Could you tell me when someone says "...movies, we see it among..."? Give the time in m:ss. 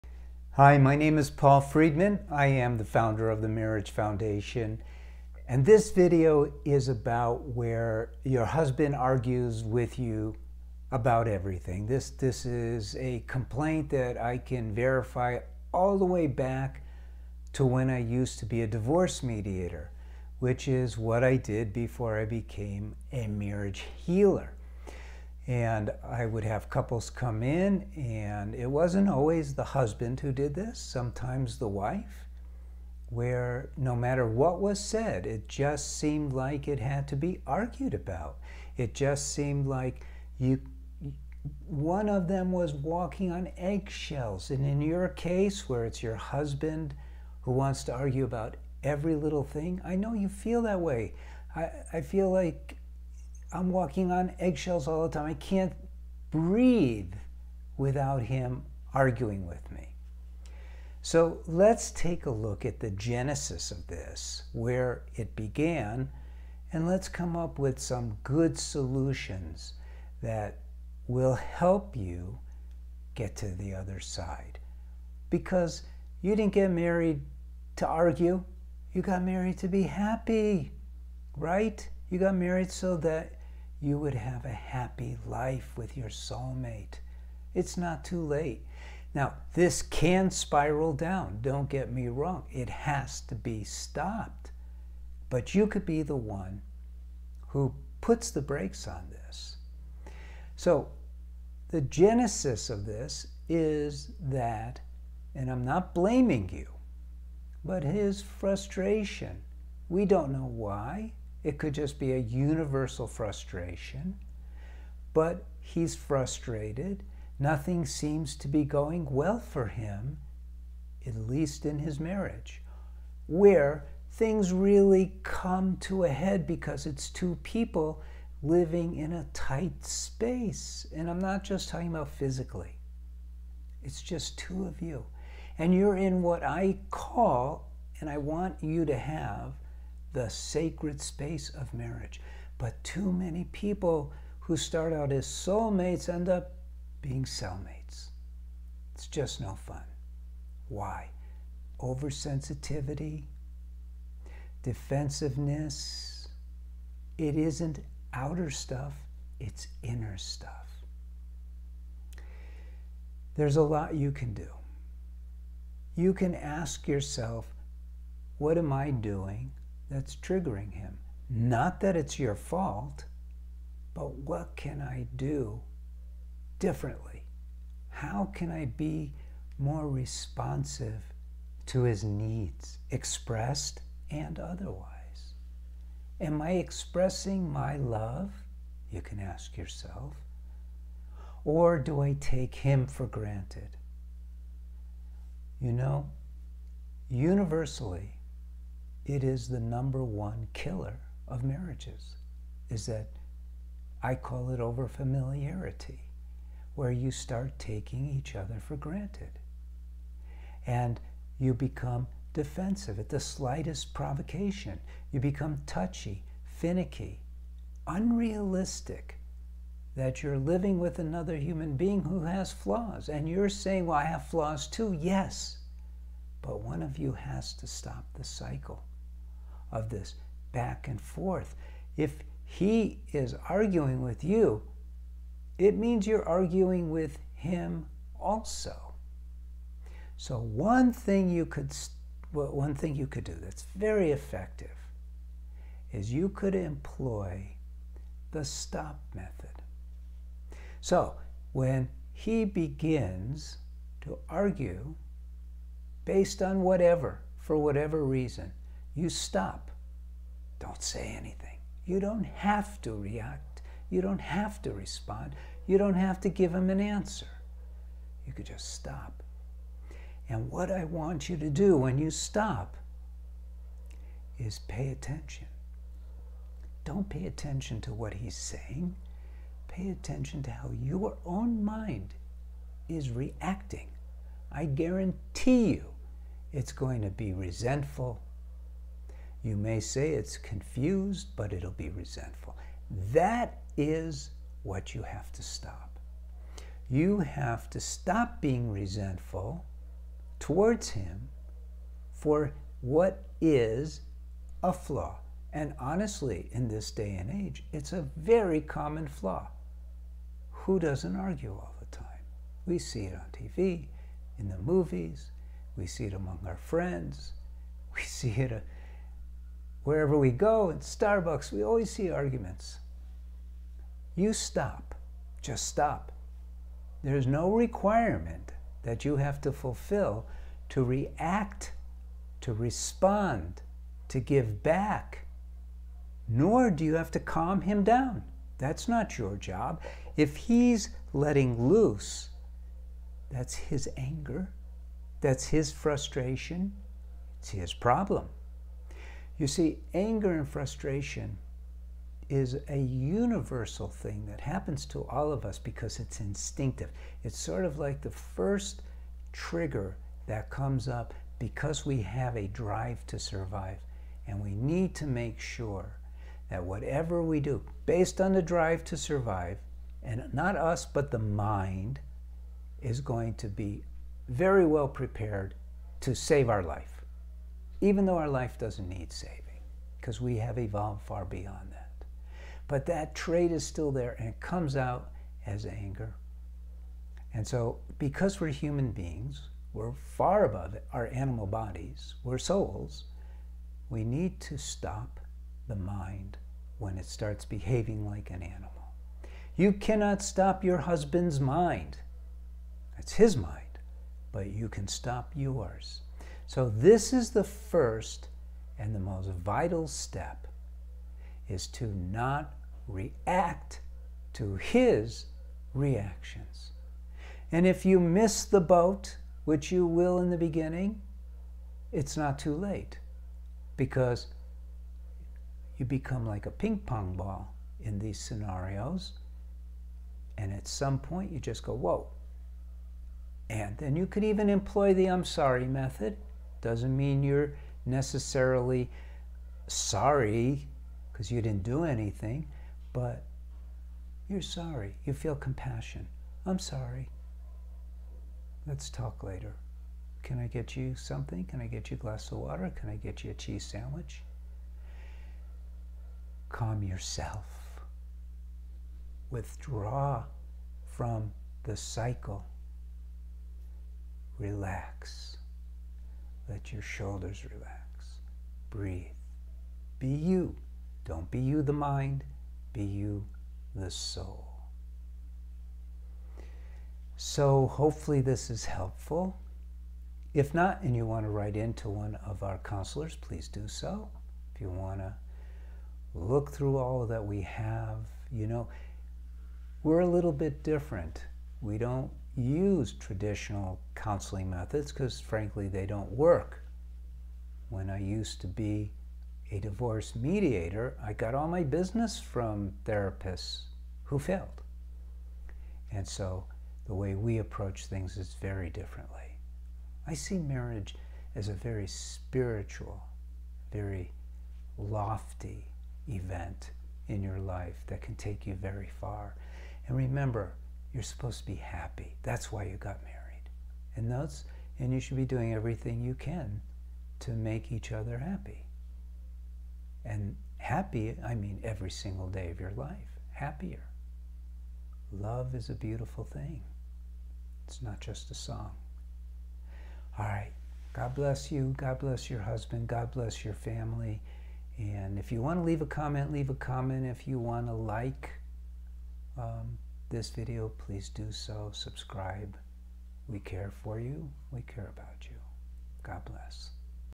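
5:14.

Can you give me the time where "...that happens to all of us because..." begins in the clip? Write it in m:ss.
5:54.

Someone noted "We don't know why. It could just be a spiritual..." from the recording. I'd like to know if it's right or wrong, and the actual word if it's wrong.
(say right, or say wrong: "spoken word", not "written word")
wrong: "universal", not "spiritual".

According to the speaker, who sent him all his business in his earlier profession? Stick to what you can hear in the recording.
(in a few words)
Therapists who failed.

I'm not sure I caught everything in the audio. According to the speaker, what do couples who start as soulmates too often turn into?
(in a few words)
Cellmates.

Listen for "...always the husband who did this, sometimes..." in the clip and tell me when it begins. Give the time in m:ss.
0:29.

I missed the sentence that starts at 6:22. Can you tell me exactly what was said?
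But that trait is still there and it comes out as anger.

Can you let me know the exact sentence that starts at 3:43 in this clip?
And you're saying, Well, I have flaws too.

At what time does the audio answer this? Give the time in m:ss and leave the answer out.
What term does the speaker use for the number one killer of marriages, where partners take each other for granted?
3:24.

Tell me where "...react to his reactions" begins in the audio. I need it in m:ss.
6:52.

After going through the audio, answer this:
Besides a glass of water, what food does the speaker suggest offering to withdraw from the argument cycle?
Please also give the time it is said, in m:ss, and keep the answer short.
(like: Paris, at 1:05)
A cheese sandwich, at 7:33.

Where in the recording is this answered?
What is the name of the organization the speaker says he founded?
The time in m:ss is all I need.
0:03.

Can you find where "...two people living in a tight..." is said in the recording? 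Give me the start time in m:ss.
2:07.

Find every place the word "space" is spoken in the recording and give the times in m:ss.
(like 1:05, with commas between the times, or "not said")
2:09, 2:21.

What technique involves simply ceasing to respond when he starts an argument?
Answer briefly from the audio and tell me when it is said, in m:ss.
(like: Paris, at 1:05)
The stop method, at 4:08.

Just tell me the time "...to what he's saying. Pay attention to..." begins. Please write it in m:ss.
4:37.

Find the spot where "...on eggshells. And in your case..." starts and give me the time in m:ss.
0:43.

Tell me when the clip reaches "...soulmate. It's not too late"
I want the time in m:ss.
1:26.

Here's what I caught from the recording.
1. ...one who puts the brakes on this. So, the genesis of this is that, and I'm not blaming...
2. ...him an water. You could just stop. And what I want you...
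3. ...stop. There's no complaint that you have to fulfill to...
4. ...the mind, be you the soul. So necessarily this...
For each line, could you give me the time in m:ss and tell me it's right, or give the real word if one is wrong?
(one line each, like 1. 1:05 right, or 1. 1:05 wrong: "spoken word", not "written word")
1. 1:36 right
2. 4:26 wrong: "answer", not "water"
3. 5:25 wrong: "requirement", not "complaint"
4. 7:51 wrong: "hopefully", not "necessarily".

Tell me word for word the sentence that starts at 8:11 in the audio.
We don't use traditional counseling methods because, frankly, they don't work.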